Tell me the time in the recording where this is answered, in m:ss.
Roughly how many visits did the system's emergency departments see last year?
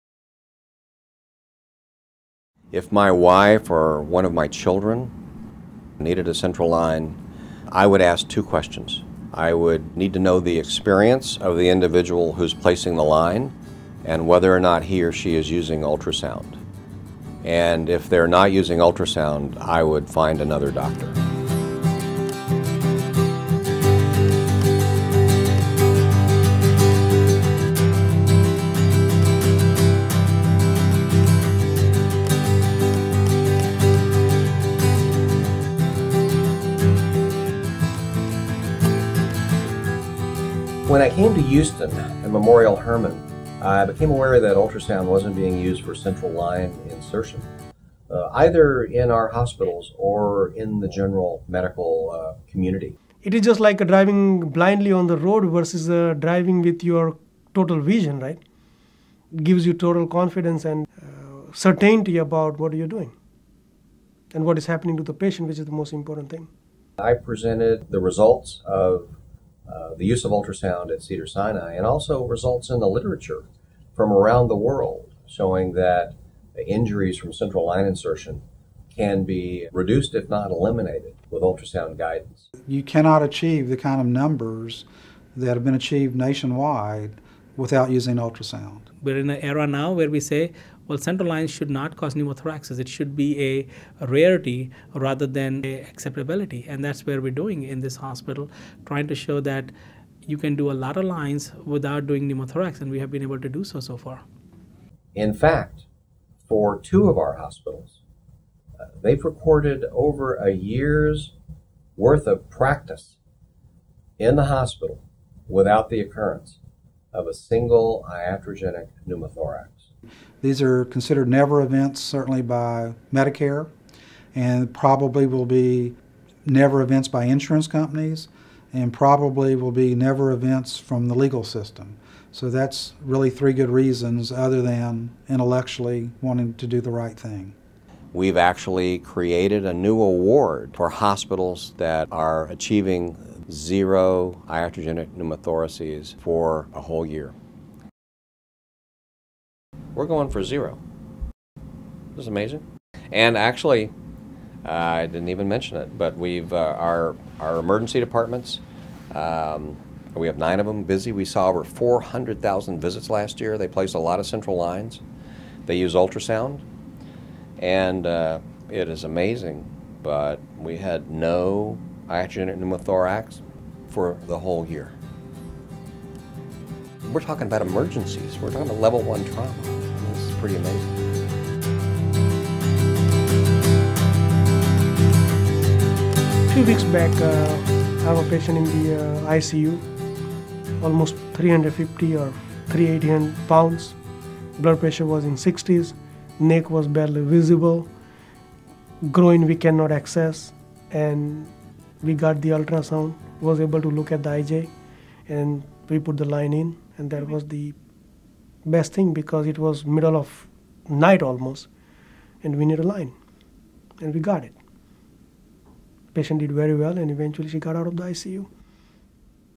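2:41.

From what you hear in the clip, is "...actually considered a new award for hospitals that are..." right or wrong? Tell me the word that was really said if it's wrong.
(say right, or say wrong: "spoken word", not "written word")
wrong: "created", not "considered".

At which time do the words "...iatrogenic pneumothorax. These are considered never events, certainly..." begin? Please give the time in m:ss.
1:58.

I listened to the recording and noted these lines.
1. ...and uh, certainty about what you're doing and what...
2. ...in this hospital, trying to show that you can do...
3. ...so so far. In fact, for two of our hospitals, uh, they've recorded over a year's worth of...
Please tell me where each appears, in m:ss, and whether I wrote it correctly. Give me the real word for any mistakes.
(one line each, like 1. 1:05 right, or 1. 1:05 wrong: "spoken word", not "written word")
1. 1:00 right
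2. 1:37 right
3. 1:43 right.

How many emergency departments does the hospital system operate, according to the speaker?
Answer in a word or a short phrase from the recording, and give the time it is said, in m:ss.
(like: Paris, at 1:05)
9, at 2:40.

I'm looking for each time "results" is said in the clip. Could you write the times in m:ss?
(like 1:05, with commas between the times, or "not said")
1:08, 1:12.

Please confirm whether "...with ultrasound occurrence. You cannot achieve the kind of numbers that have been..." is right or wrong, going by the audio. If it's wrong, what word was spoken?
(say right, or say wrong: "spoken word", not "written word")
wrong: "guidance", not "occurrence".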